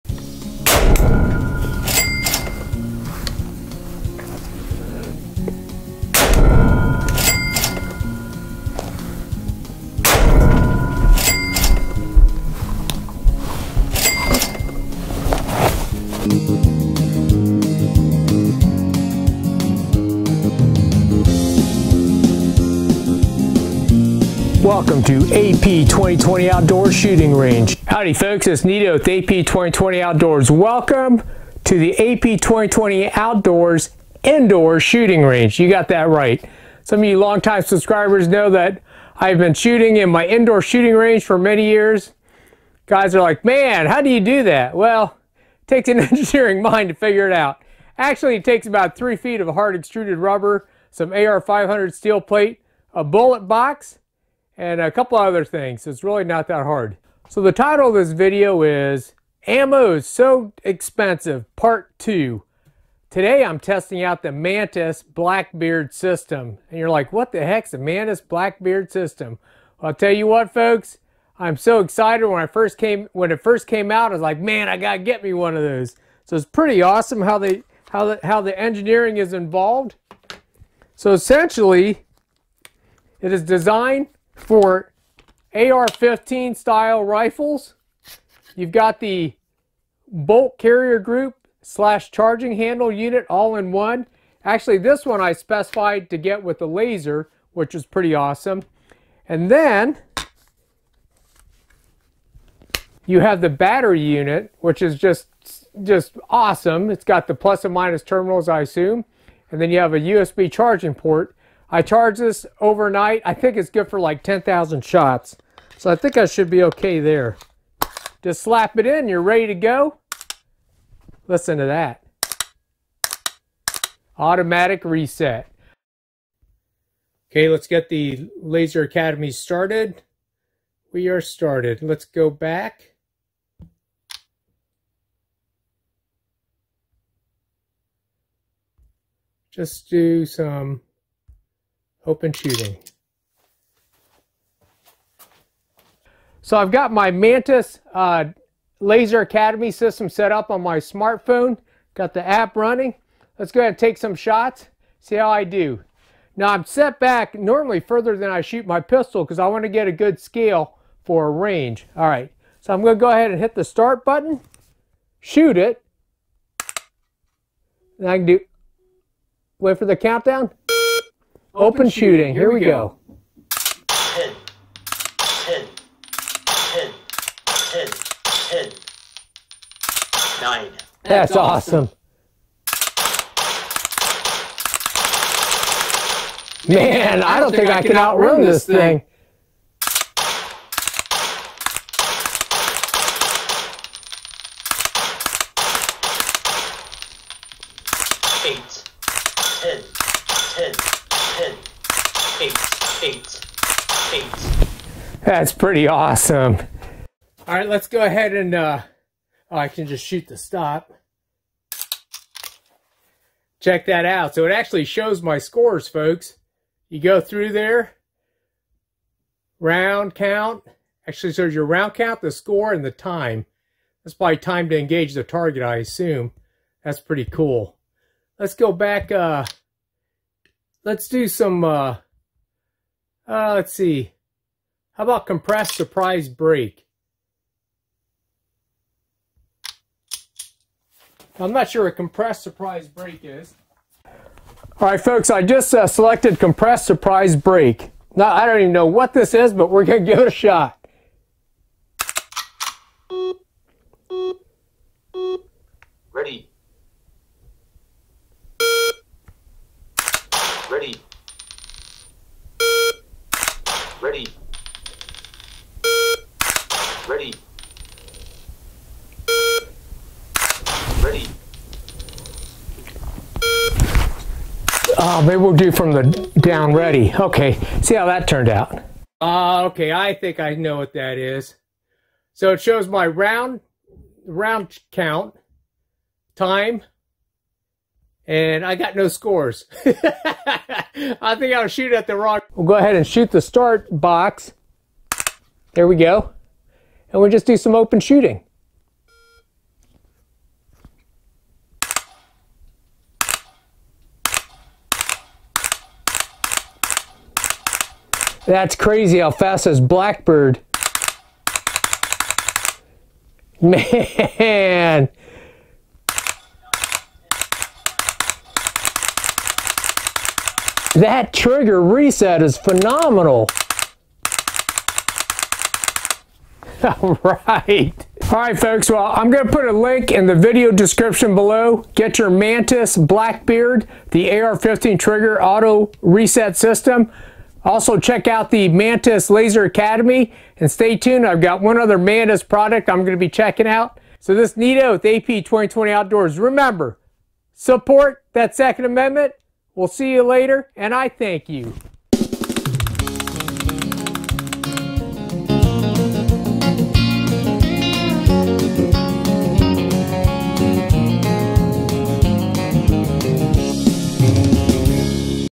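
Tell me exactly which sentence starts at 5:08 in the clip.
That's crazy how fast is Blackbeard.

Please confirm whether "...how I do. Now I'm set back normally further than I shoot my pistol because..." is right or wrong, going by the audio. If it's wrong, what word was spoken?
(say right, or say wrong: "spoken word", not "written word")
right.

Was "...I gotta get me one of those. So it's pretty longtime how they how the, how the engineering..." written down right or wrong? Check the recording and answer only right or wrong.
wrong.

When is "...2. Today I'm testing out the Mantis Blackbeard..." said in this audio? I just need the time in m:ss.
1:01.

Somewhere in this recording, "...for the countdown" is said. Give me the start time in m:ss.
2:49.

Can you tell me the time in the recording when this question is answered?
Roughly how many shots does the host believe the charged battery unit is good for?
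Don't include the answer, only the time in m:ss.
1:54.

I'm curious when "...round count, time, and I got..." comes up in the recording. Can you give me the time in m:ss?
4:44.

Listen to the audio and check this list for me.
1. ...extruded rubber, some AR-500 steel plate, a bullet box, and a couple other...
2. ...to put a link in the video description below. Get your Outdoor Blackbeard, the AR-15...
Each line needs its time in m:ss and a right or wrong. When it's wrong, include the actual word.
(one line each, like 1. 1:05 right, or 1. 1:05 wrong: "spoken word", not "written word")
1. 0:49 right
2. 5:29 wrong: "Mantis", not "Outdoor".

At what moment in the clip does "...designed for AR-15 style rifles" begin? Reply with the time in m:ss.
1:23.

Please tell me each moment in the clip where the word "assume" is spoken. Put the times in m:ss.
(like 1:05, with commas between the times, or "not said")
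1:48, 3:45.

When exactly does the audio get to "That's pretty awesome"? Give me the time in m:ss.
3:25.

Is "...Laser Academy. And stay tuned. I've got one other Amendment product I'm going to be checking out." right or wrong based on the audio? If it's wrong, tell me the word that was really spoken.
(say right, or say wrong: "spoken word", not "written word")
wrong: "Mantis", not "Amendment".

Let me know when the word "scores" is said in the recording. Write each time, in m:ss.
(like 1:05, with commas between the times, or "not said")
3:35, 3:42, 4:49.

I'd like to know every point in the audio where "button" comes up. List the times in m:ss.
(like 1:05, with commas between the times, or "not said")
2:44.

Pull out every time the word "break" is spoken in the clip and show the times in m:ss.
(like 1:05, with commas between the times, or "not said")
3:56, 4:02, 4:07.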